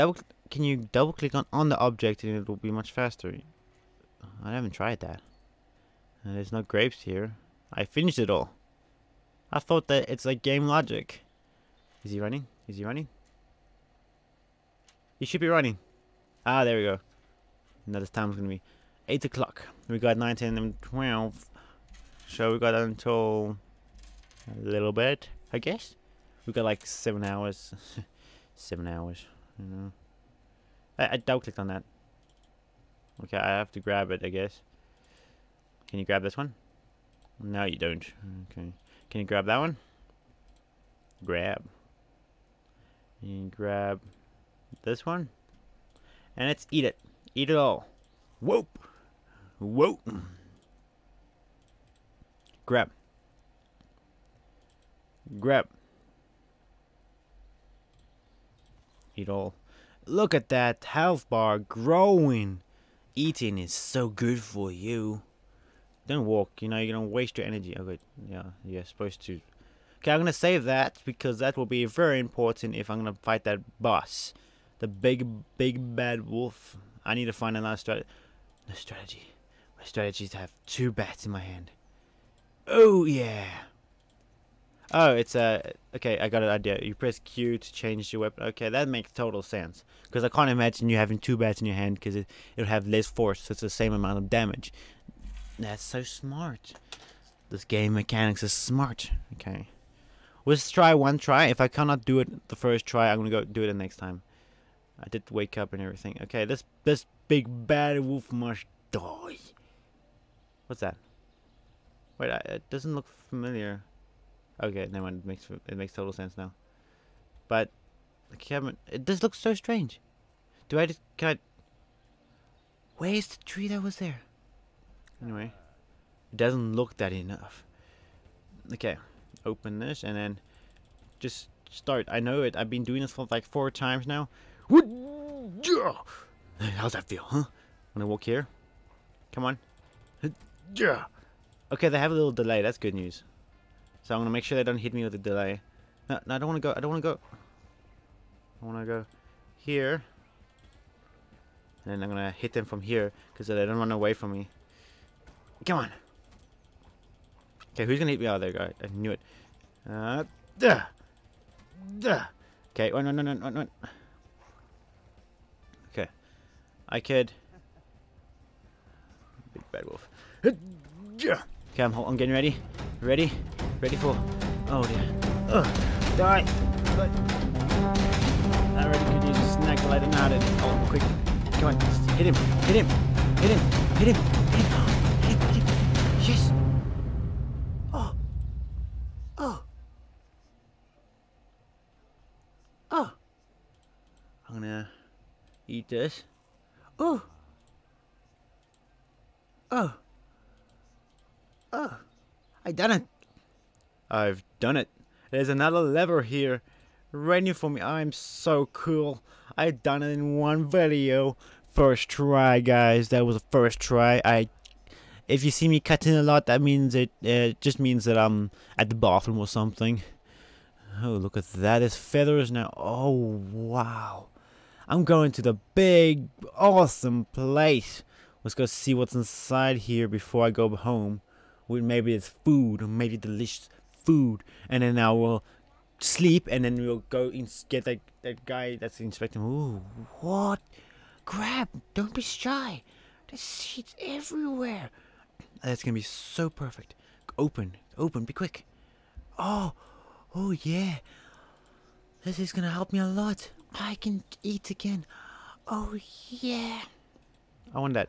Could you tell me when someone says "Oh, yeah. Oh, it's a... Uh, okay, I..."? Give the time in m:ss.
1:22.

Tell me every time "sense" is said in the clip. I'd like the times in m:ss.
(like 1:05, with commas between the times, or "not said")
1:29, 1:56.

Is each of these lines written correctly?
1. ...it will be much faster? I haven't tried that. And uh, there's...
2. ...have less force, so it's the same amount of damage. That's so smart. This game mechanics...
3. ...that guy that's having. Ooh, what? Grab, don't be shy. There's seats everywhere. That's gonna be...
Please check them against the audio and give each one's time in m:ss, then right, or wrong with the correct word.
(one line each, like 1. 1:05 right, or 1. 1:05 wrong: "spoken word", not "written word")
1. 0:02 right
2. 1:32 right
3. 3:58 wrong: "inspecting", not "having".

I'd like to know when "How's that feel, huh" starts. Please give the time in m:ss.
2:16.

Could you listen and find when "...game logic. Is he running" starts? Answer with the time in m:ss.
0:10.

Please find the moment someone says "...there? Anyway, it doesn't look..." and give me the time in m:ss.
2:03.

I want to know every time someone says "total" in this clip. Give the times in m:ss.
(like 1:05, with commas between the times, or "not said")
1:29, 1:55.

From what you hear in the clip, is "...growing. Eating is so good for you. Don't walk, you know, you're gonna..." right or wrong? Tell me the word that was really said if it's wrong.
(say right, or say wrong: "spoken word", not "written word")
right.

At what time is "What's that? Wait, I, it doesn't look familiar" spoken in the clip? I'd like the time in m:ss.
1:50.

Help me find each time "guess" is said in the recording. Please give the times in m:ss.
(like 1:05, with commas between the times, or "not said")
0:25, 0:34.